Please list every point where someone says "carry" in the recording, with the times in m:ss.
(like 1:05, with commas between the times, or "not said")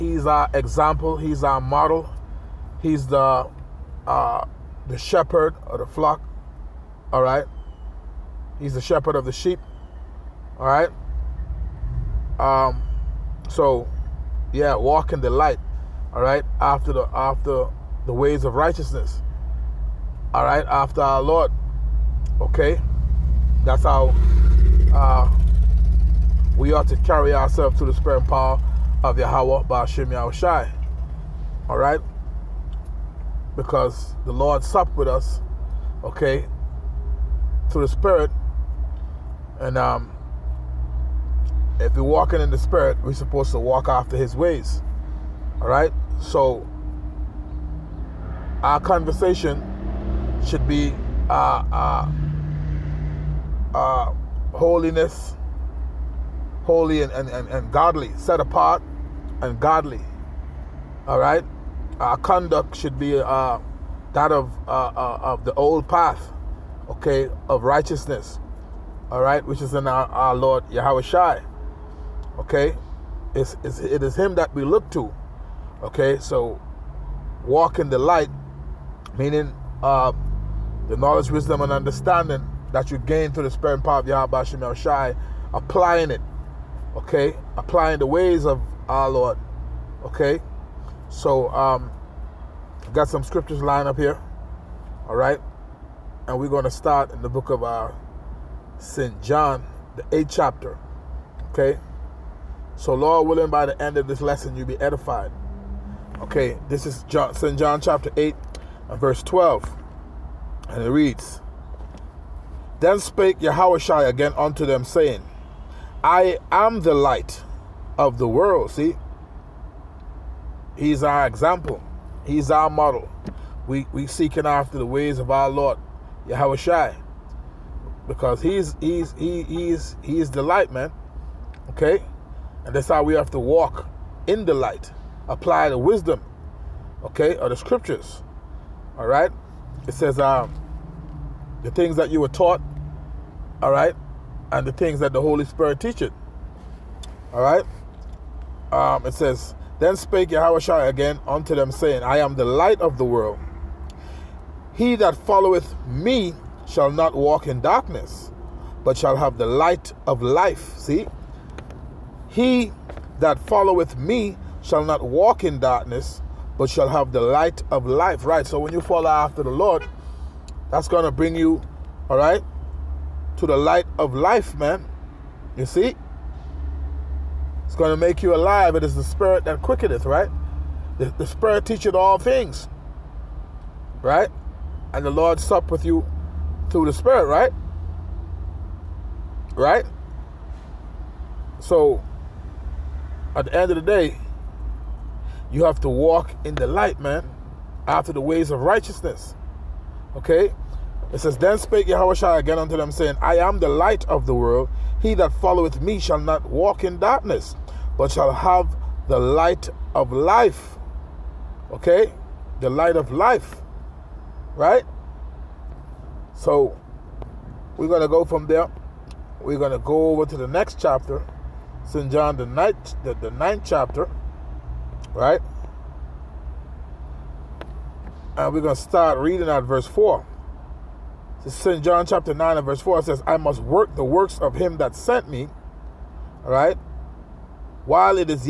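0:26.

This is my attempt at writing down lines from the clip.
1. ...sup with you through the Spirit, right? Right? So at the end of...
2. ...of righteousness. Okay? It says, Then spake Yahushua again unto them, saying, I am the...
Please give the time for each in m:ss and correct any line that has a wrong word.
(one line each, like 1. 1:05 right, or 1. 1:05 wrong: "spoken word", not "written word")
1. 3:05 right
2. 3:18 right.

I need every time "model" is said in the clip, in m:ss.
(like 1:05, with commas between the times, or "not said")
0:01, 2:02.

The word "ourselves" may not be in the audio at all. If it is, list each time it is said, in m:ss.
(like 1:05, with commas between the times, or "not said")
0:27.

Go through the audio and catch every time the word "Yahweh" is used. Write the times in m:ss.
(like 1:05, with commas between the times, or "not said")
0:29, 1:10, 1:24.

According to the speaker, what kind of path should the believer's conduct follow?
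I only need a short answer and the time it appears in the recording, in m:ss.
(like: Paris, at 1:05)
The old path, at 1:05.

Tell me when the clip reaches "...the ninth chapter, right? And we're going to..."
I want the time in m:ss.
3:43.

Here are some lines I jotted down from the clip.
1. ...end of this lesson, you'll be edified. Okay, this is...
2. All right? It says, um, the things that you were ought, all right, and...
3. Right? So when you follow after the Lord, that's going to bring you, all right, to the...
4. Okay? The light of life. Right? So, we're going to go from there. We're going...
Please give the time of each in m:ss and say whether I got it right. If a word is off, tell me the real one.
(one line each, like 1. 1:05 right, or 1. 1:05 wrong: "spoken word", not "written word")
1. 1:43 right
2. 2:18 wrong: "taught", not "ought"
3. 2:48 right
4. 3:31 right.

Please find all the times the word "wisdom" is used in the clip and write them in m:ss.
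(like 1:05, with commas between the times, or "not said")
1:21, 2:15.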